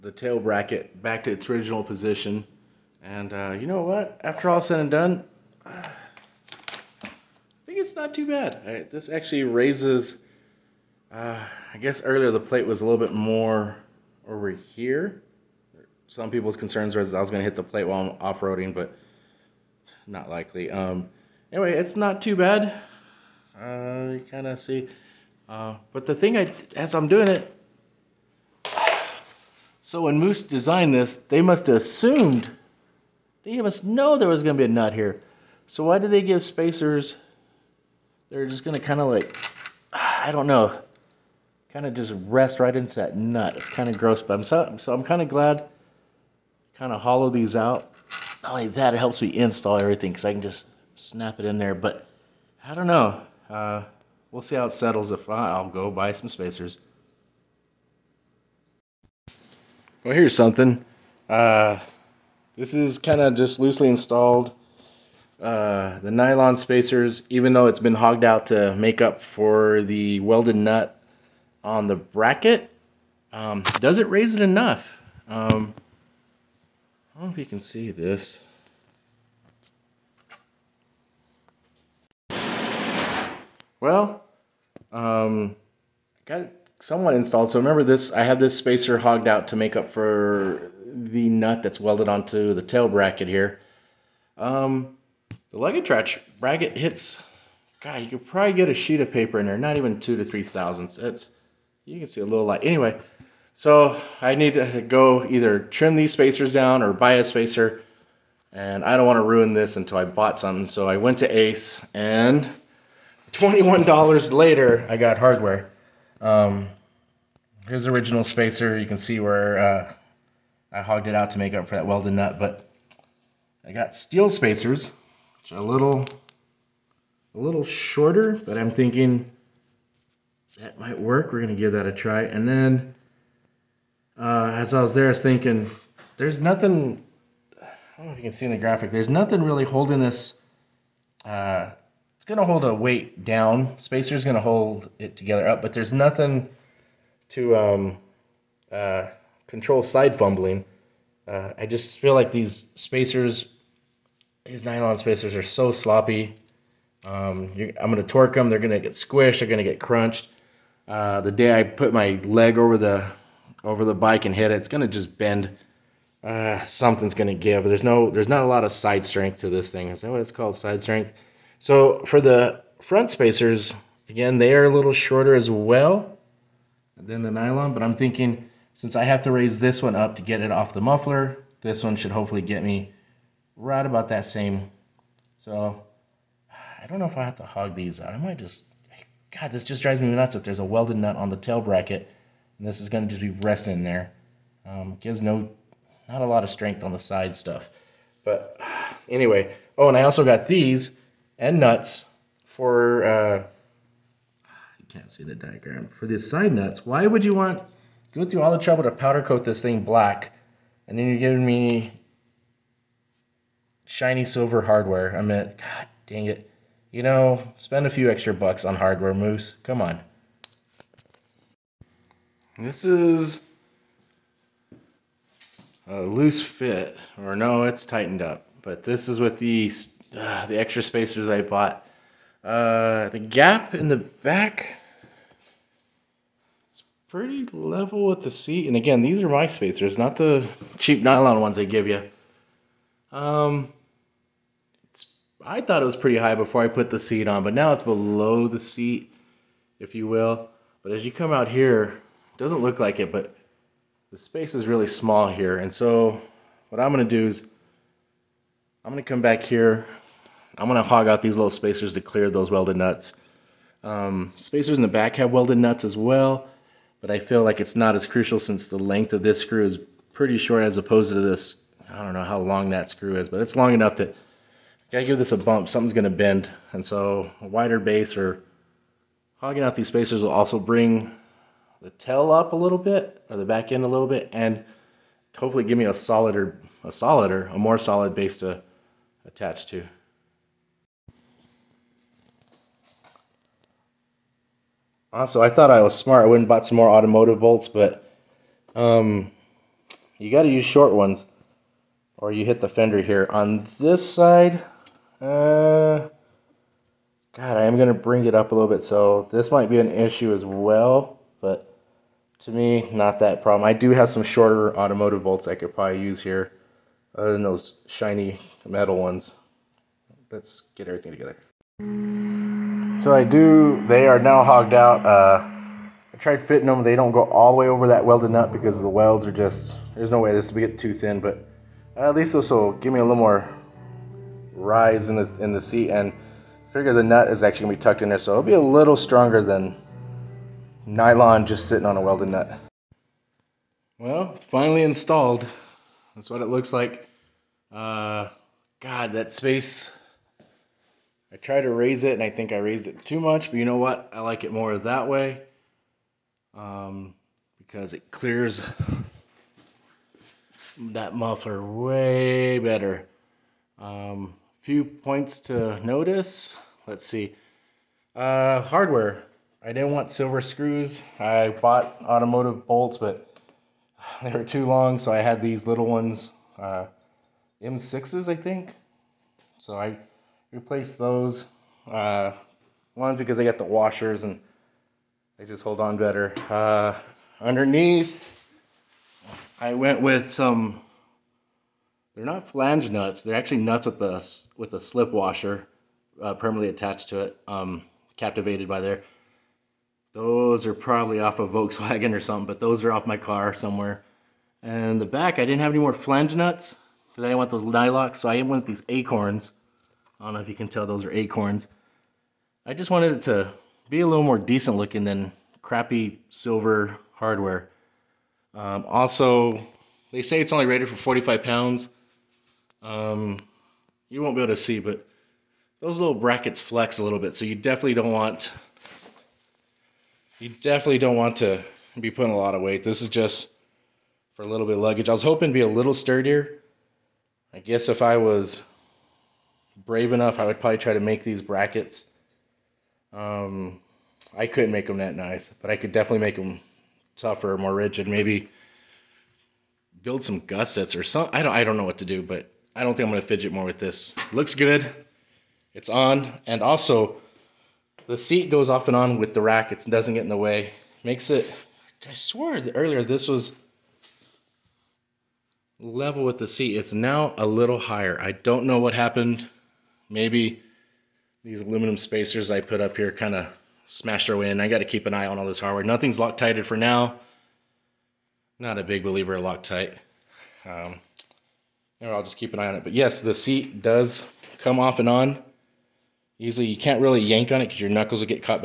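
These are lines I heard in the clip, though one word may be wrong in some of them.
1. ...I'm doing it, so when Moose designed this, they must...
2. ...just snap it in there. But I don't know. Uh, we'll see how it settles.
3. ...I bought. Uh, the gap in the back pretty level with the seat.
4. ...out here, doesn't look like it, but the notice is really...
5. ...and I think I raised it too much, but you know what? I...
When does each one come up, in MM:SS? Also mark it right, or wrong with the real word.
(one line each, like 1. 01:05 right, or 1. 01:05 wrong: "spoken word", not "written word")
1. 00:26 right
2. 00:50 right
3. 03:51 right
4. 04:11 wrong: "space", not "notice"
5. 05:52 right.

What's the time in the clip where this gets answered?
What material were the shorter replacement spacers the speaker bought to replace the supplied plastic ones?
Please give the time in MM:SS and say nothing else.
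02:03.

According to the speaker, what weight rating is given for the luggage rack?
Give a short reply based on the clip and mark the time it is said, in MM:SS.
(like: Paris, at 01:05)
45 pounds, at 07:00.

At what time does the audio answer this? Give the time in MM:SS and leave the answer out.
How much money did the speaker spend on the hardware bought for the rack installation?
01:53.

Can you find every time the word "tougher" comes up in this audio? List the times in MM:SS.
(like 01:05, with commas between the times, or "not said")
07:27.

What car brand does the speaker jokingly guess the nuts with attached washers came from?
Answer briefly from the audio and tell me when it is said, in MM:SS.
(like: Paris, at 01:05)
Volkswagen, at 06:41.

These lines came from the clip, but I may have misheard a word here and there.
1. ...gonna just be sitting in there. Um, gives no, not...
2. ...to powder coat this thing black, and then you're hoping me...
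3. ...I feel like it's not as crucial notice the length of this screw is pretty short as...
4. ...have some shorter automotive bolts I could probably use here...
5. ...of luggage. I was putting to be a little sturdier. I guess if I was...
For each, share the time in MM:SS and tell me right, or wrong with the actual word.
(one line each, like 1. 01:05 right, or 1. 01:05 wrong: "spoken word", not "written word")
1. 03:12 wrong: "resting", not "sitting"
2. 03:28 wrong: "giving", not "hoping"
3. 04:27 wrong: "since", not "notice"
4. 05:13 right
5. 07:14 wrong: "hoping", not "putting".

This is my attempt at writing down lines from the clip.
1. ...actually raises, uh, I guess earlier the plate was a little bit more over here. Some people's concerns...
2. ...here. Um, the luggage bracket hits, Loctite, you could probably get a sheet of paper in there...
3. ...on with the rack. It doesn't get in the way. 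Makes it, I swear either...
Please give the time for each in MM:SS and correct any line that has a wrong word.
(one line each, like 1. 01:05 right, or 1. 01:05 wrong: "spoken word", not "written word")
1. 00:09 right
2. 01:33 wrong: "God", not "Loctite"
3. 07:38 wrong: "earlier", not "either".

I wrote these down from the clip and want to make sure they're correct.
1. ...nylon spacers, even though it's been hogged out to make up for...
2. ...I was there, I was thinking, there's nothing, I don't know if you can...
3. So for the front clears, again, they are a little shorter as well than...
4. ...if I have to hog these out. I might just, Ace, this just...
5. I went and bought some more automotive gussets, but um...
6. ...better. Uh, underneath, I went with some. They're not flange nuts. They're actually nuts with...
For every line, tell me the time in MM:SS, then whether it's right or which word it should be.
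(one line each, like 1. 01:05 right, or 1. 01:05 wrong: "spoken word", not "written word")
1. 01:06 right
2. 02:14 right
3. 02:51 wrong: "spacers", not "clears"
4. 03:07 wrong: "God", not "Ace"
5. 04:56 wrong: "bolts", not "gussets"
6. 06:25 right.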